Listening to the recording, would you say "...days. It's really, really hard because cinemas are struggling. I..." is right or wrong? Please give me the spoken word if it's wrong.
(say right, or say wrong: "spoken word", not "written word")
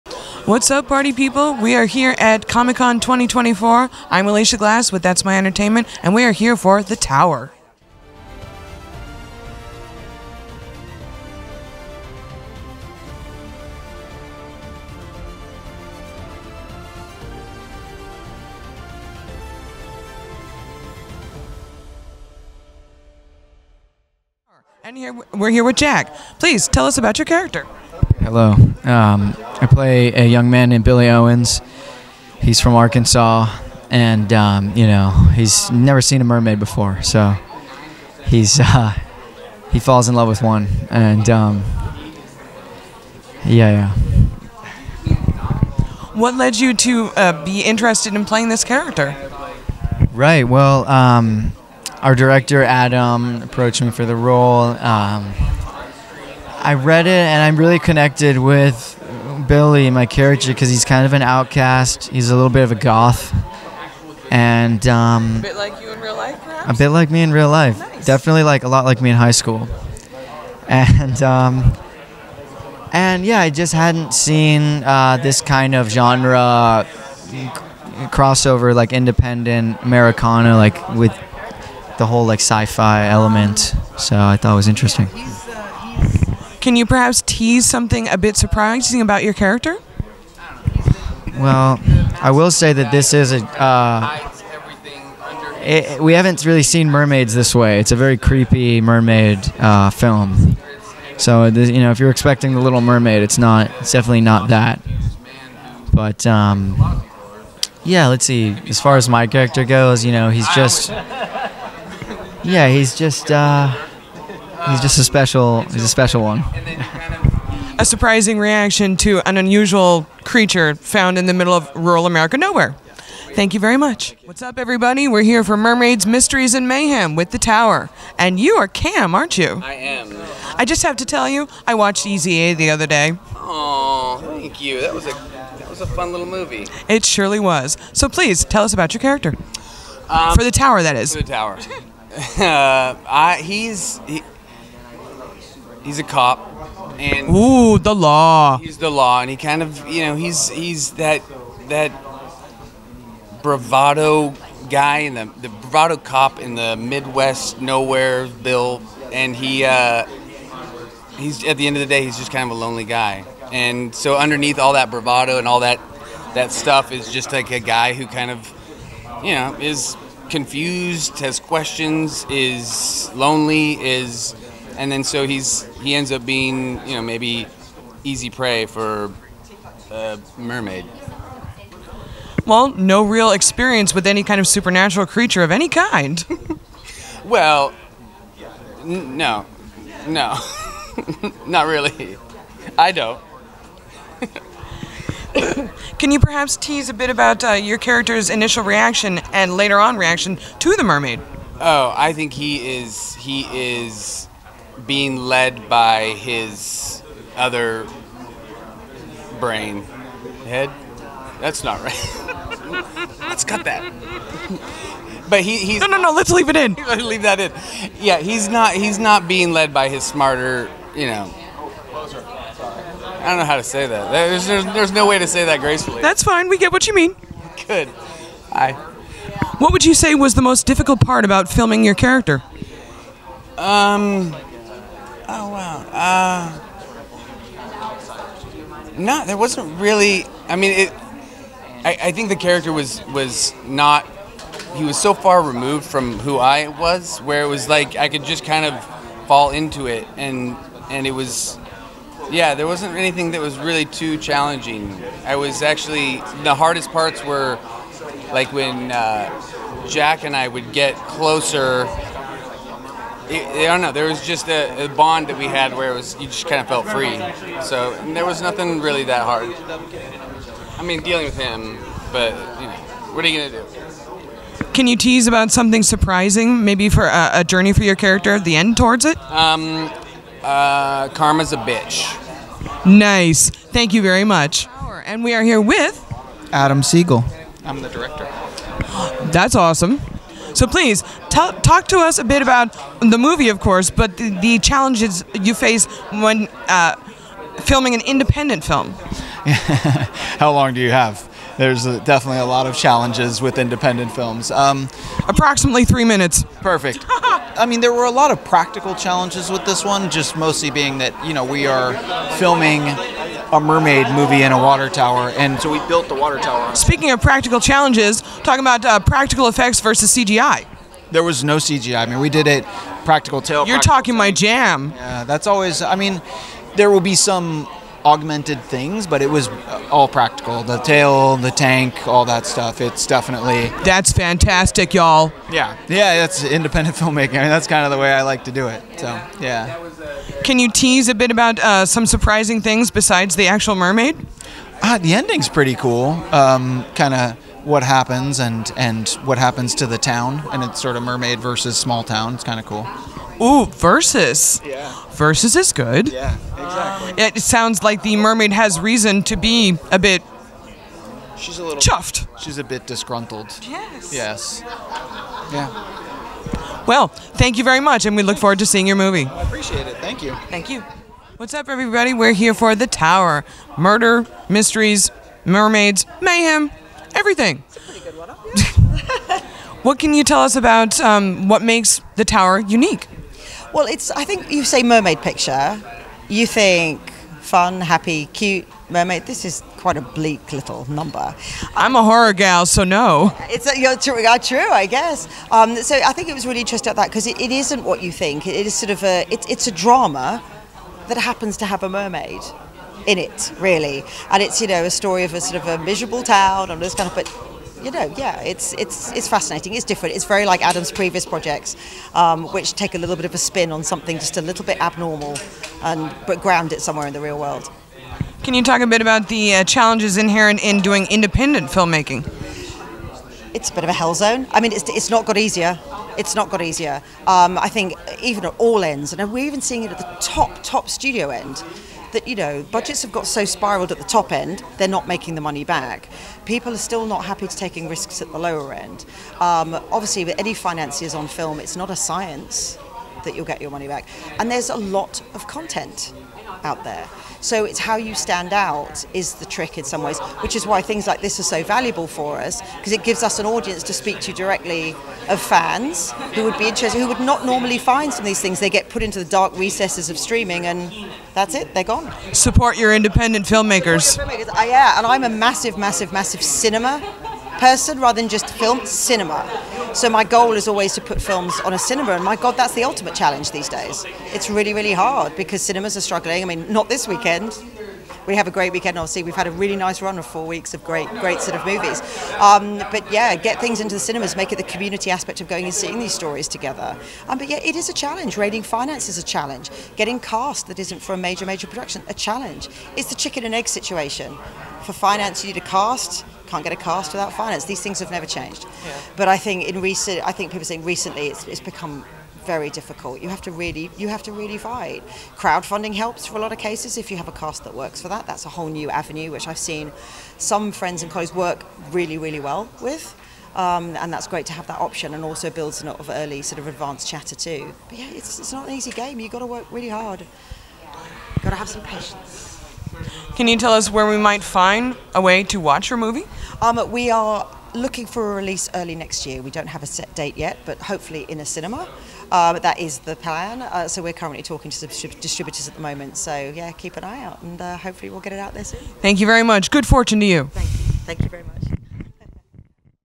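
right.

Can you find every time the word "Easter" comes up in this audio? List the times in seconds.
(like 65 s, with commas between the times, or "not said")
not said.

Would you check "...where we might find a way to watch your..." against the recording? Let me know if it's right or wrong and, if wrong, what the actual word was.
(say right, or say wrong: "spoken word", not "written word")
right.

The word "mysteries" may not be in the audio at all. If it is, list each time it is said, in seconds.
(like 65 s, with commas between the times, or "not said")
126 s, 374 s.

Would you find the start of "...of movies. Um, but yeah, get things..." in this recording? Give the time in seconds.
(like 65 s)
481 s.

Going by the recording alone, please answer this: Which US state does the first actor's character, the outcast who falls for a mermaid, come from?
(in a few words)
Arkansas.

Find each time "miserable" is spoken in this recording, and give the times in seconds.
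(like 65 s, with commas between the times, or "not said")
405 s.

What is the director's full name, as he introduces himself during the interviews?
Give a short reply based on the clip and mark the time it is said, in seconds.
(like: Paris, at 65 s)
Adam Sigal, at 286 s.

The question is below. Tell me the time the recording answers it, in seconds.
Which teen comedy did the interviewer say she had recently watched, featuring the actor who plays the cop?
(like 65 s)
132 s.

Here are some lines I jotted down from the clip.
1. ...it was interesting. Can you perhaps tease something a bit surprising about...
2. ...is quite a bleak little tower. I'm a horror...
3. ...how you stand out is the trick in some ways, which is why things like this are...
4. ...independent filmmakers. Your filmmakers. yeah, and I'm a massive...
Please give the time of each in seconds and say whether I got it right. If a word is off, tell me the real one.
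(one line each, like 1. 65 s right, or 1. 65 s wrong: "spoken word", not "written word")
1. 84 s right
2. 389 s wrong: "number", not "tower"
3. 447 s right
4. 462 s right.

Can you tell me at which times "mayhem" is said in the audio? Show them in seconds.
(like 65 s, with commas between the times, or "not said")
126 s, 376 s.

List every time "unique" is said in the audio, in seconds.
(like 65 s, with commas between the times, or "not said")
382 s.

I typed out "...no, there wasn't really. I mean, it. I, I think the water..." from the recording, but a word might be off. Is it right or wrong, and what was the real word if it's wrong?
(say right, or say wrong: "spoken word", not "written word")
wrong: "character", not "water".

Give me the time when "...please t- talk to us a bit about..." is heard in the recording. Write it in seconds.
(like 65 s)
290 s.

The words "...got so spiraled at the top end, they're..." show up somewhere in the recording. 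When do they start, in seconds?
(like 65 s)
433 s.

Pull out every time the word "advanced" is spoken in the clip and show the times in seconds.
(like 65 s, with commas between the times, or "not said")
516 s.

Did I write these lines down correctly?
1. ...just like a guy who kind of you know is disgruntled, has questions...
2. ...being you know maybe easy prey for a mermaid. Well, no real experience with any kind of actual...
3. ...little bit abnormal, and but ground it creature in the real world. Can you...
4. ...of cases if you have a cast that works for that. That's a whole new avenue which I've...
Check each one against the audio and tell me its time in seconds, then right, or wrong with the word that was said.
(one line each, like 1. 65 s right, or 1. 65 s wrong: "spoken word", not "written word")
1. 167 s wrong: "confused", not "disgruntled"
2. 176 s wrong: "supernatural", not "actual"
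3. 414 s wrong: "somewhere", not "creature"
4. 506 s right.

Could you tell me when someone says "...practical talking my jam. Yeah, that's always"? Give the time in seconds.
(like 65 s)
323 s.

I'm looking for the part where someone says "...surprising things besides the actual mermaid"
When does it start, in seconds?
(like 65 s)
342 s.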